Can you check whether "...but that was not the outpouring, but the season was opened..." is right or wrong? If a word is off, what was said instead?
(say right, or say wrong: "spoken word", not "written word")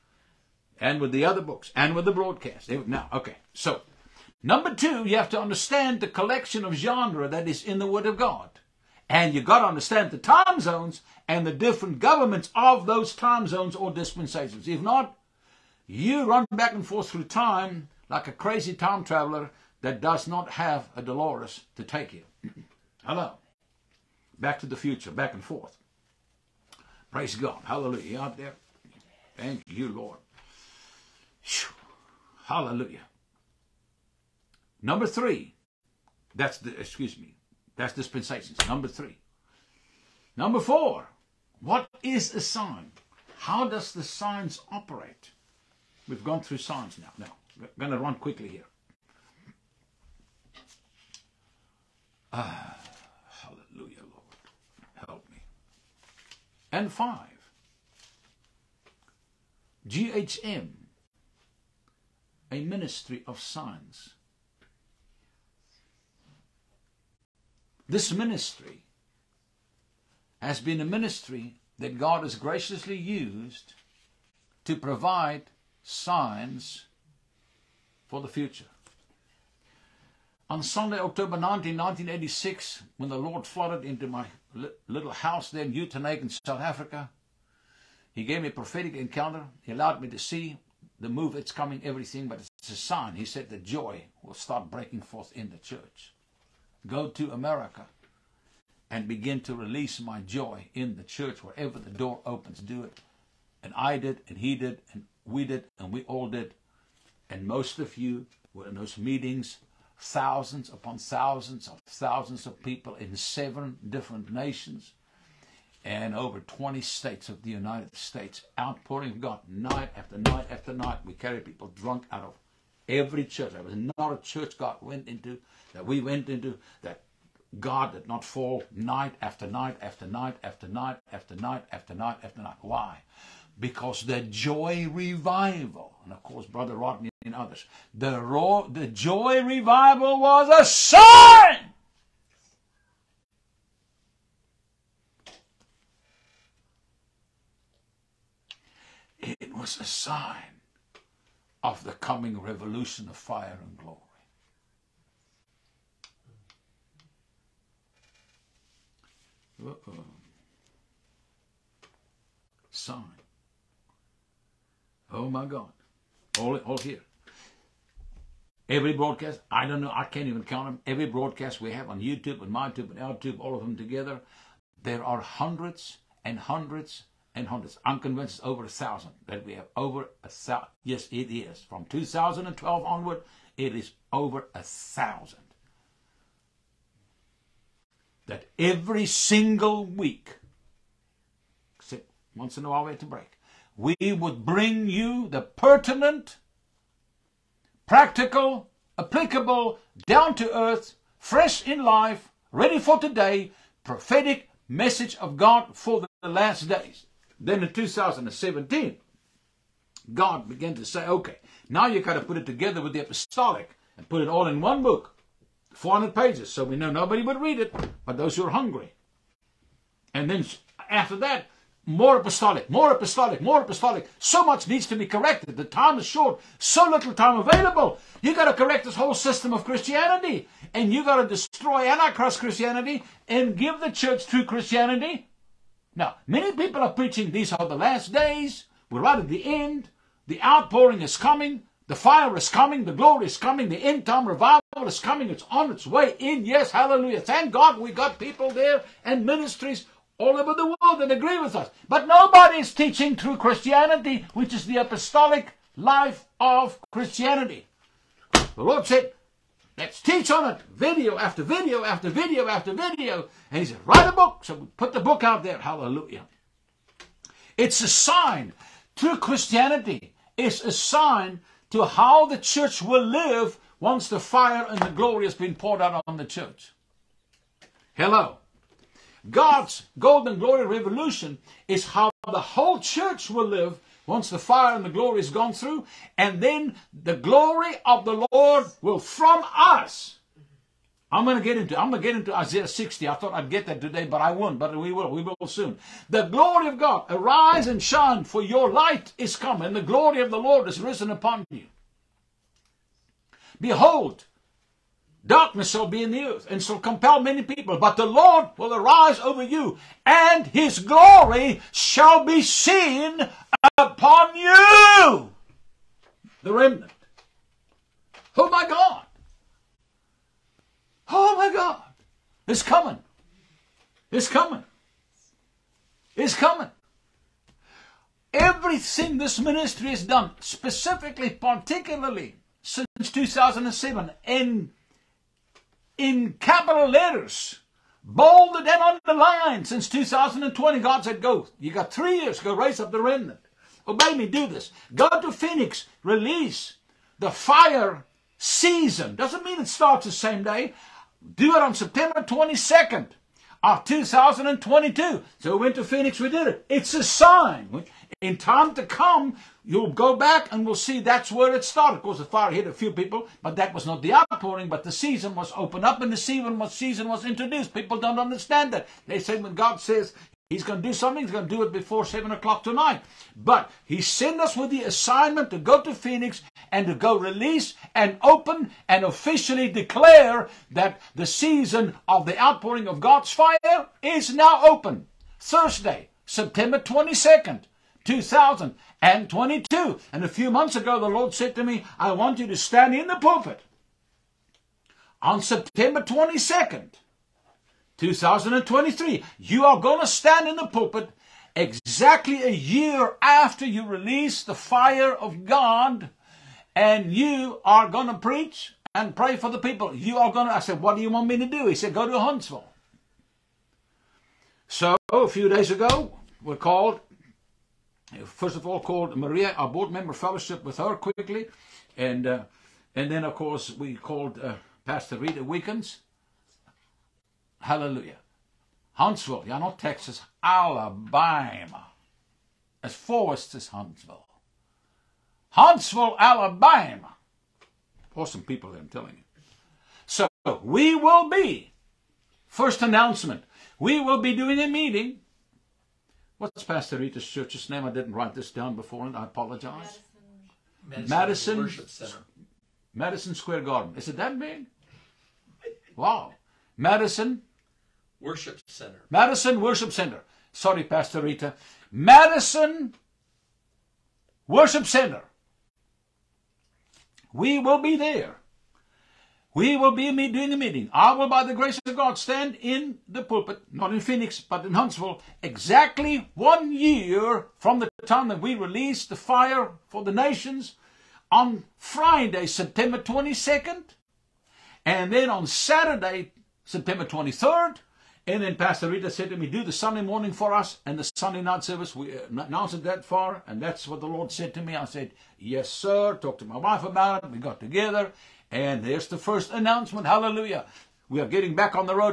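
right.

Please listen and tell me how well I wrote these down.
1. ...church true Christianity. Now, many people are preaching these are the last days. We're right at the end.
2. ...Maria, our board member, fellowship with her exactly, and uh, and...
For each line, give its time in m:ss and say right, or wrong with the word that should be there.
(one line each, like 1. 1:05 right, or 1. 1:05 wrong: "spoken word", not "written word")
1. 3:53 right
2. 6:59 wrong: "quickly", not "exactly".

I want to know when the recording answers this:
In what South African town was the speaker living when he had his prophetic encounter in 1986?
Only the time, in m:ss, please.
1:25.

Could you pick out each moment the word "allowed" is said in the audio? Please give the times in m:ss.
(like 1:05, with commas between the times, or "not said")
1:29.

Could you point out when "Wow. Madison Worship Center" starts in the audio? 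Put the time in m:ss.
7:35.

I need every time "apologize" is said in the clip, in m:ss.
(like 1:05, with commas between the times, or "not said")
7:29.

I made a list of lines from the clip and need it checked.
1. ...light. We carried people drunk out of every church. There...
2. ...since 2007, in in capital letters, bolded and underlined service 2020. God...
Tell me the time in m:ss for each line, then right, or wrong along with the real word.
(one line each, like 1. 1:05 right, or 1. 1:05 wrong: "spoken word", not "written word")
1. 2:00 wrong: "night", not "light"
2. 5:32 wrong: "since", not "service".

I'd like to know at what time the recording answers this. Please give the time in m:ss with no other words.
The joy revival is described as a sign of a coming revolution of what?
2:33.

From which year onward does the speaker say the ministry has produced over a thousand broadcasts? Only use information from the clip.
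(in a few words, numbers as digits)
2012.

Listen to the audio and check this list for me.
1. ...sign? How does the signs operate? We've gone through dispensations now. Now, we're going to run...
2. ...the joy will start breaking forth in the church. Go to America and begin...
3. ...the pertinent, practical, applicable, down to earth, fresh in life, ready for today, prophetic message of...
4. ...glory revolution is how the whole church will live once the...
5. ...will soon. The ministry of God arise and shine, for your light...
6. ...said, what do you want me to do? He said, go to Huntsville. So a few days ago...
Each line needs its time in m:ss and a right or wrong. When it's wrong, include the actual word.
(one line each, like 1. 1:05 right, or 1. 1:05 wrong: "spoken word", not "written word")
1. 0:42 wrong: "signs", not "dispensations"
2. 1:33 right
3. 3:15 right
4. 4:40 right
5. 4:55 wrong: "glory", not "ministry"
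6. 6:50 right.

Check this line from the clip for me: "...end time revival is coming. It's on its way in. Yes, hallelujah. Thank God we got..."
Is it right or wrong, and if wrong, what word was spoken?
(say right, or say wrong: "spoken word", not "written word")
right.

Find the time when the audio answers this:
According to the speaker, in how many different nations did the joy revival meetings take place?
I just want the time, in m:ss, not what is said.
1:53.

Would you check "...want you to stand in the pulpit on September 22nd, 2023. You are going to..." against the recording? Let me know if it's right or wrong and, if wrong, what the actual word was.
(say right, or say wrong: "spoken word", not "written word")
right.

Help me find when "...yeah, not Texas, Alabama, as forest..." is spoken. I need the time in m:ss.
7:09.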